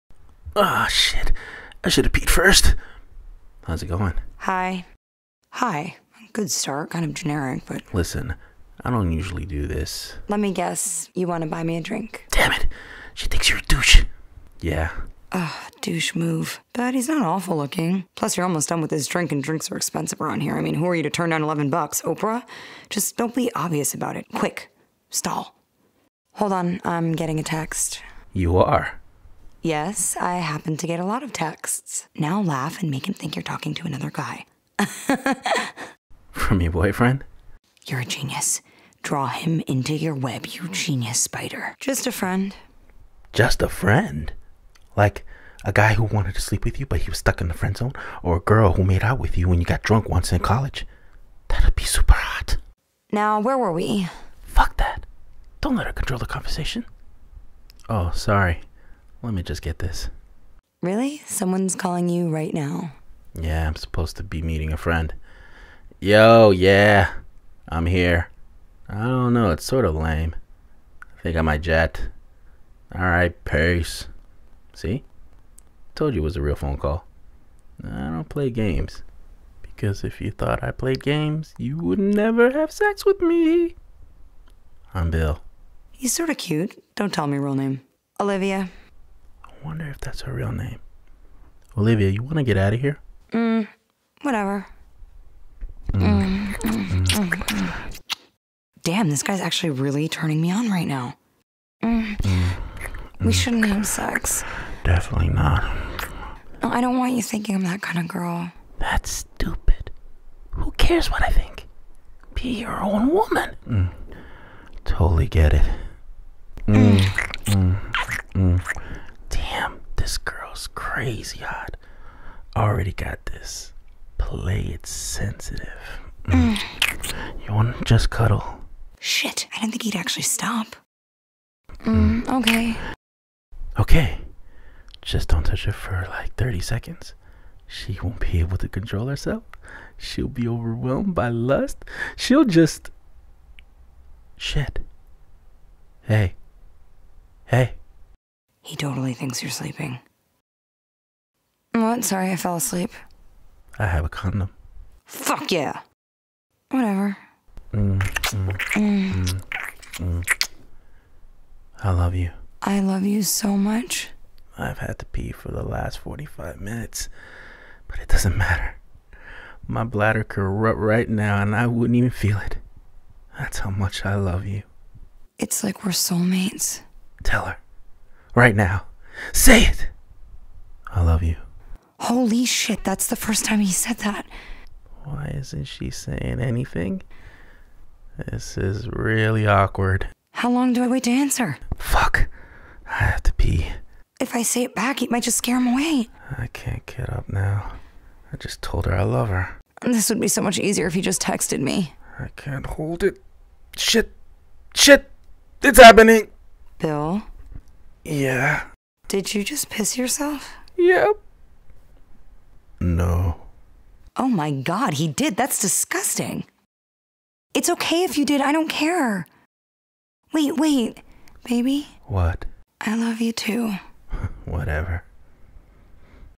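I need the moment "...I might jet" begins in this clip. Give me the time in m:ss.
1:11.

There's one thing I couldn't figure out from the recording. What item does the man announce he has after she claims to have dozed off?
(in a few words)
A condom.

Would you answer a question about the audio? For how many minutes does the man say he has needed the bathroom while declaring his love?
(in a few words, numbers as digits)
45.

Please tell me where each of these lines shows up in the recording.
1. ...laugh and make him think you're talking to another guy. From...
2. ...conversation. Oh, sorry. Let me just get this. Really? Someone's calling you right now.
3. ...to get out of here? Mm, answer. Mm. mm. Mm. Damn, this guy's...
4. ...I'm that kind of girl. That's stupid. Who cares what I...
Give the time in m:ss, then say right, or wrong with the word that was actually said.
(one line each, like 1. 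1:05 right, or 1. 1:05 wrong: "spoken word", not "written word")
1. 0:32 right
2. 0:56 right
3. 1:32 wrong: "whatever", not "answer"
4. 1:47 right.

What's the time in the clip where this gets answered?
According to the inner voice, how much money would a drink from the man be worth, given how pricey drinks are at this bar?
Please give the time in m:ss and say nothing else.
0:21.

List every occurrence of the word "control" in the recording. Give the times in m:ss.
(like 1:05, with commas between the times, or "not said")
0:55, 2:18.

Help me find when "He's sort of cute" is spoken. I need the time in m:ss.
1:25.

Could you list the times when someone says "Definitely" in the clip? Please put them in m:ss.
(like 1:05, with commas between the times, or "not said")
1:44.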